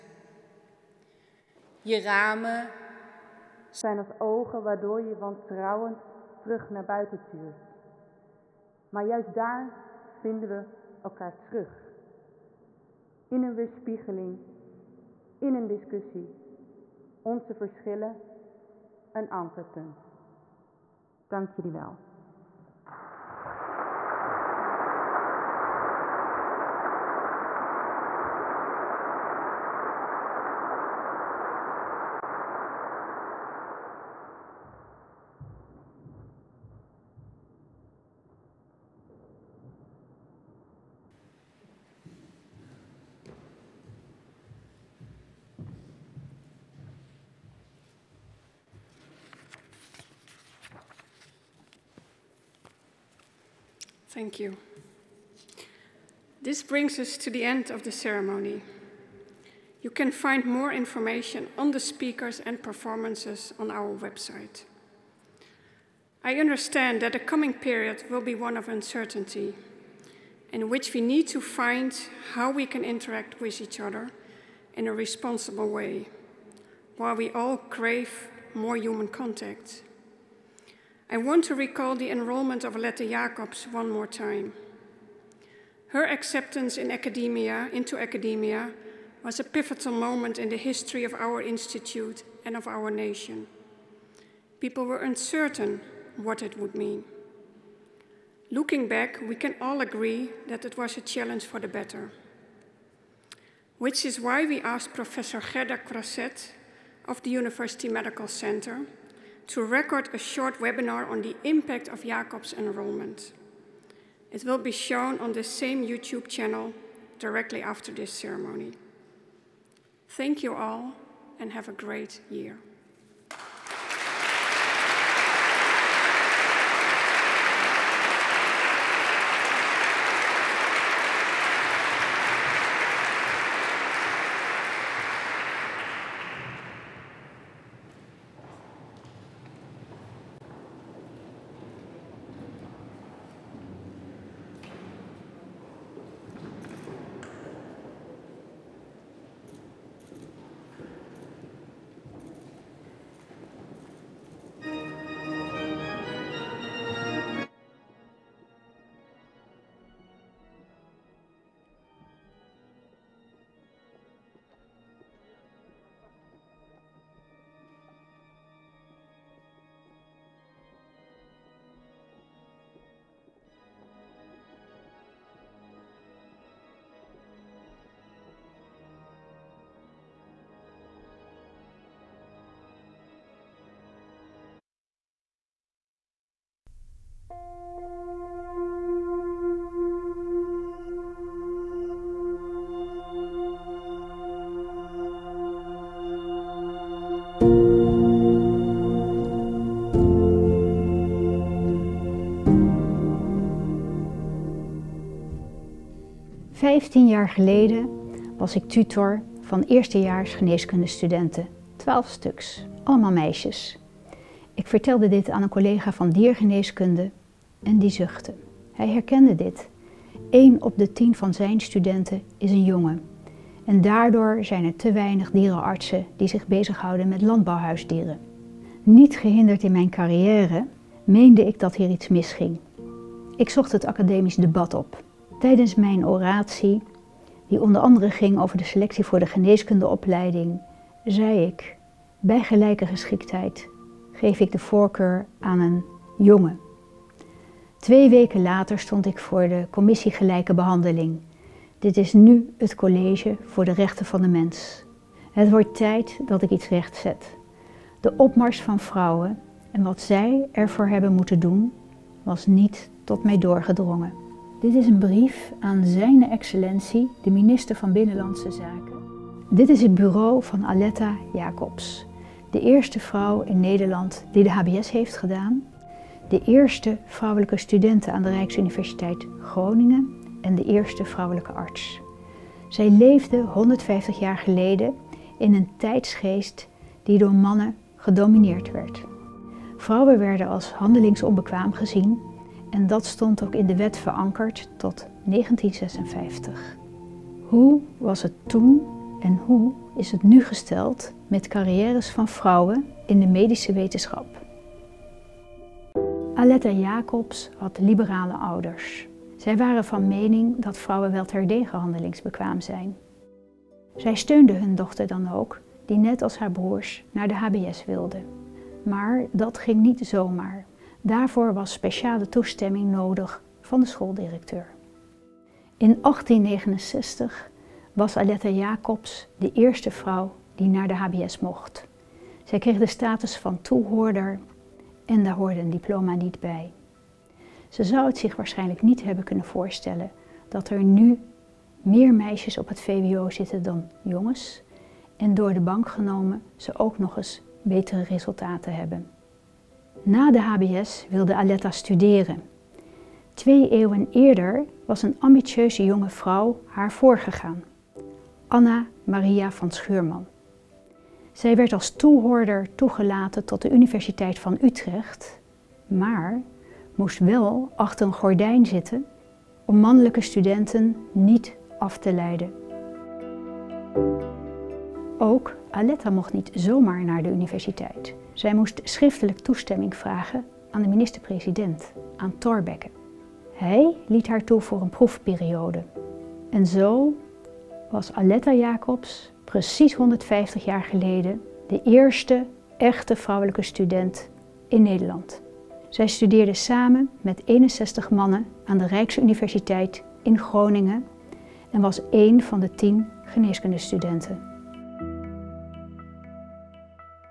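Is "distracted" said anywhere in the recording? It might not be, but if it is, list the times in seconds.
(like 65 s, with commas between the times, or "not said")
not said.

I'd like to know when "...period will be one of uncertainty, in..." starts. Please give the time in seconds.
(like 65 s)
67 s.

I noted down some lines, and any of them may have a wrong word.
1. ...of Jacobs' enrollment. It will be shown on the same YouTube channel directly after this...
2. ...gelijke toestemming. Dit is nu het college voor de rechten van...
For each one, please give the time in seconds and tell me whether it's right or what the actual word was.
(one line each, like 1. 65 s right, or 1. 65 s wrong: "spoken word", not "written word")
1. 111 s right
2. 250 s wrong: "behandeling", not "toestemming".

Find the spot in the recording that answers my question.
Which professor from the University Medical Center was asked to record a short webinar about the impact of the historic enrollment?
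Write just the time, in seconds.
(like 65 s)
105 s.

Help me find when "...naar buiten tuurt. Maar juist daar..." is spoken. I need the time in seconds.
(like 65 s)
6 s.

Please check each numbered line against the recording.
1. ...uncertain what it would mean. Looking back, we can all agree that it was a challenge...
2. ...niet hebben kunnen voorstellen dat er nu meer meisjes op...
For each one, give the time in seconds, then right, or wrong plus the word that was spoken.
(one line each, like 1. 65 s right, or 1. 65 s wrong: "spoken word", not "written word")
1. 95 s right
2. 338 s right.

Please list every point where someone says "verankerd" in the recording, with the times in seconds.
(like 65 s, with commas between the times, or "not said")
293 s.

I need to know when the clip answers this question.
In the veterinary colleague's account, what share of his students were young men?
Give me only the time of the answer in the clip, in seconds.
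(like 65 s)
220 s.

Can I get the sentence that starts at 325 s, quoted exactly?
In 1869 was Aletta Jacobs de eerste vrouw die naar de HBS mocht.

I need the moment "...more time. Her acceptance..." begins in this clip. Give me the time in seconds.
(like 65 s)
83 s.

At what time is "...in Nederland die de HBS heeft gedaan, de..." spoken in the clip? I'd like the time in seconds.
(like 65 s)
273 s.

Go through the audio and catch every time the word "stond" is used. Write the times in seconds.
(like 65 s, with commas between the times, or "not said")
248 s, 293 s.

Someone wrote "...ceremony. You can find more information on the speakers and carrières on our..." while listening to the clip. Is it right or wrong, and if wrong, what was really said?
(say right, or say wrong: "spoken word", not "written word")
wrong: "performances", not "carrières".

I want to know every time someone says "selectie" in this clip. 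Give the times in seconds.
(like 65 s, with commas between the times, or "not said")
238 s.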